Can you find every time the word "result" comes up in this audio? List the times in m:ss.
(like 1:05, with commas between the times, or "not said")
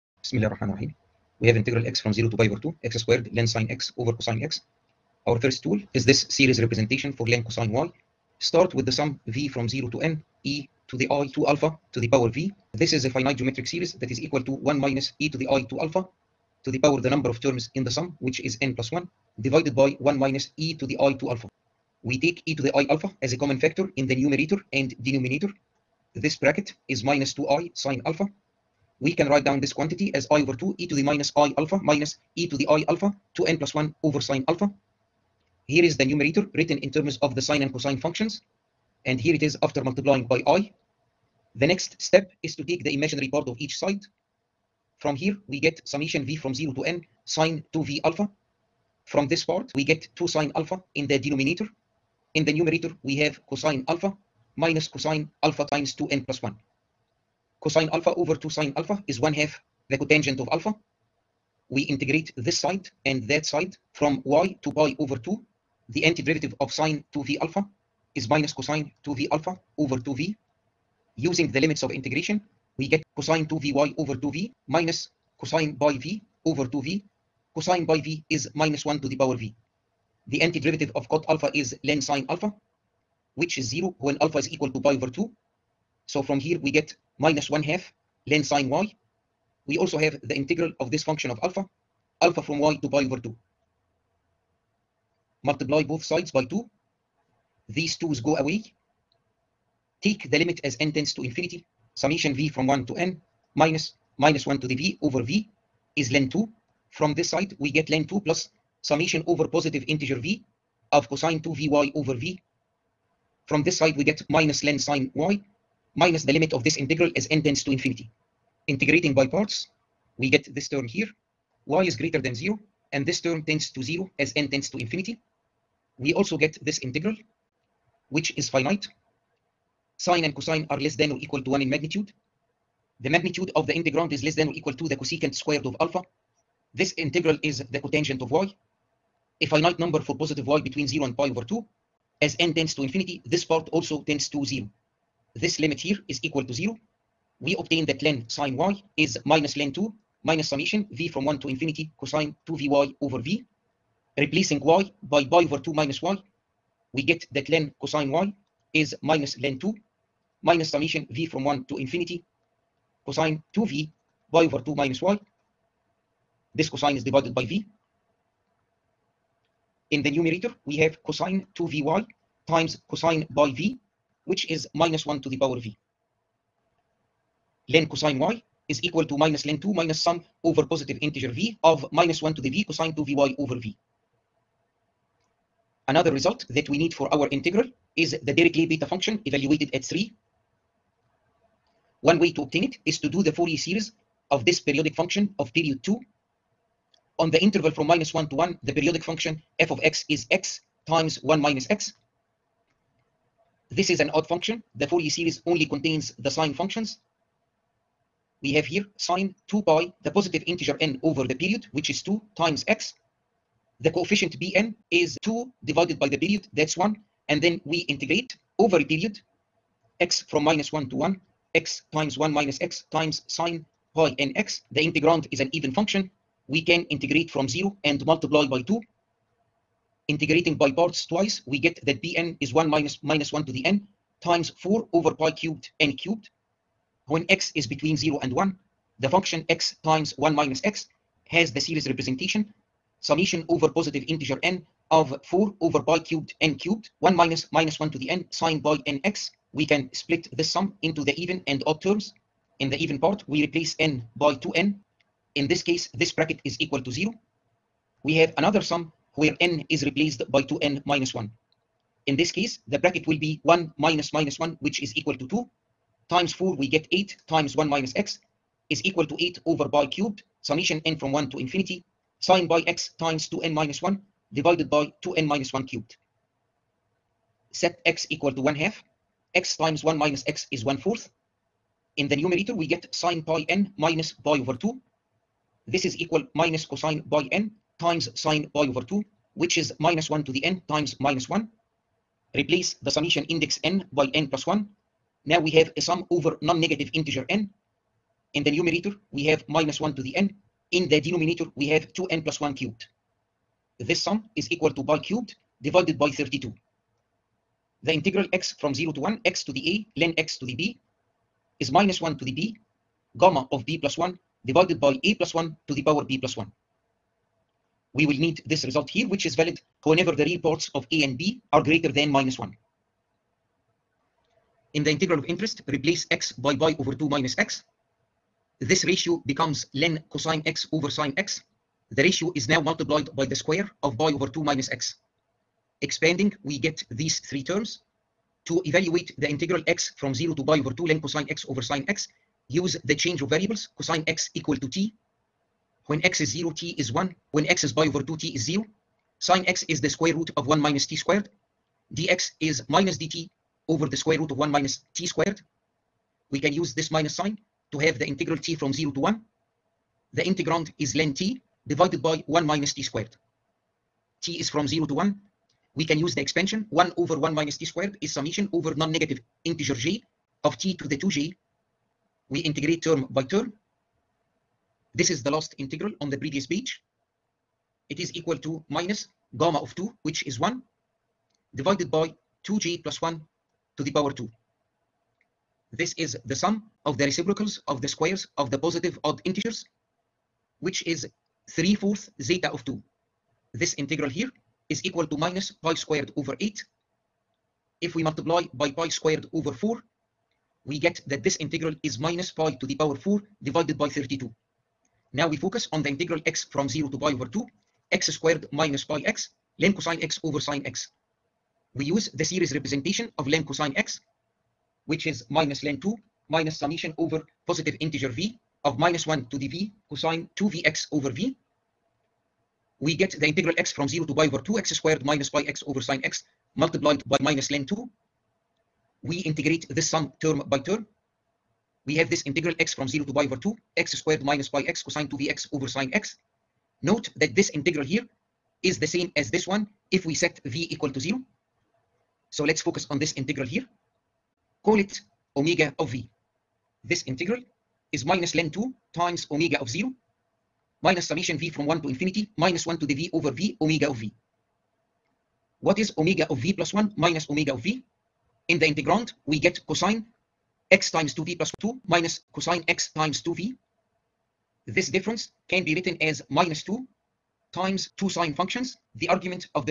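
3:06, 5:18.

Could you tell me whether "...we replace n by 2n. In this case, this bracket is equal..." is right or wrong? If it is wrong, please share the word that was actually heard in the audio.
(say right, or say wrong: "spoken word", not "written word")
right.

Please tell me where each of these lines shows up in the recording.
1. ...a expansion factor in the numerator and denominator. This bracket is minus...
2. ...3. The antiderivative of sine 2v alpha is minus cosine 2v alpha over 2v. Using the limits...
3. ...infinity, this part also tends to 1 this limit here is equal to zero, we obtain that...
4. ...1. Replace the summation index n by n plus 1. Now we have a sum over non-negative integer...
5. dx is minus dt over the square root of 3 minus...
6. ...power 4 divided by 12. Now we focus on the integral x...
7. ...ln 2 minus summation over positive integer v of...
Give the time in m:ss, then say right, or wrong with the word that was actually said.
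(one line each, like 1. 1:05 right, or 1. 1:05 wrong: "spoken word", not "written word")
1. 0:23 wrong: "common", not "expansion"
2. 1:05 wrong: "2", not "3"
3. 2:22 wrong: "0", not "1"
4. 4:51 right
5. 5:51 wrong: "1", not "3"
6. 6:42 wrong: "32", not "12"
7. 6:55 right.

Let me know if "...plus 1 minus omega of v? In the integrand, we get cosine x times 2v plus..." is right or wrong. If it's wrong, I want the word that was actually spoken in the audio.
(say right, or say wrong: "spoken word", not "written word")
right.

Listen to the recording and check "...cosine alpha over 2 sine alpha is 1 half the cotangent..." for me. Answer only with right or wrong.
right.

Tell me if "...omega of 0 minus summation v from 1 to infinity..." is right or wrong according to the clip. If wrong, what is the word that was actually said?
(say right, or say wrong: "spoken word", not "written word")
right.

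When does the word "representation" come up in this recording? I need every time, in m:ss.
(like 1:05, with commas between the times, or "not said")
0:06, 4:01, 6:52.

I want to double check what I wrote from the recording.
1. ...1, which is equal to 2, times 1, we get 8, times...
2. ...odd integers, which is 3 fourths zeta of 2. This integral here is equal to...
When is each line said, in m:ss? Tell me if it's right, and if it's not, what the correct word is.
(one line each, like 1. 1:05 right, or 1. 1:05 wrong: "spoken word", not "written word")
1. 4:24 wrong: "4", not "1"
2. 6:29 right.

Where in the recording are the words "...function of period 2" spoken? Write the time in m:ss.
3:14.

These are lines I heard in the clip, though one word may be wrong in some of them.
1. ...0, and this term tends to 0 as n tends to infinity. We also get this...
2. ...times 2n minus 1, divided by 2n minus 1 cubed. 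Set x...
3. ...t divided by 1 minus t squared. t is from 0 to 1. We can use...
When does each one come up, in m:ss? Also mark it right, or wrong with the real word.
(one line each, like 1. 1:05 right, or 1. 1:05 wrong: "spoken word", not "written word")
1. 2:02 right
2. 4:32 right
3. 6:01 right.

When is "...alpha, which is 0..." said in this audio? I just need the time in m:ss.
1:22.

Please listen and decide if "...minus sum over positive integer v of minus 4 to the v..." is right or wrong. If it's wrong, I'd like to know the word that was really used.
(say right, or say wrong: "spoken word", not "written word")
wrong: "1", not "4".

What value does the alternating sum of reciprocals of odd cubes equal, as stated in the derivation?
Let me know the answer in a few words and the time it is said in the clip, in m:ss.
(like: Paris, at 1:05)
pi cubed over 32, at 5:04.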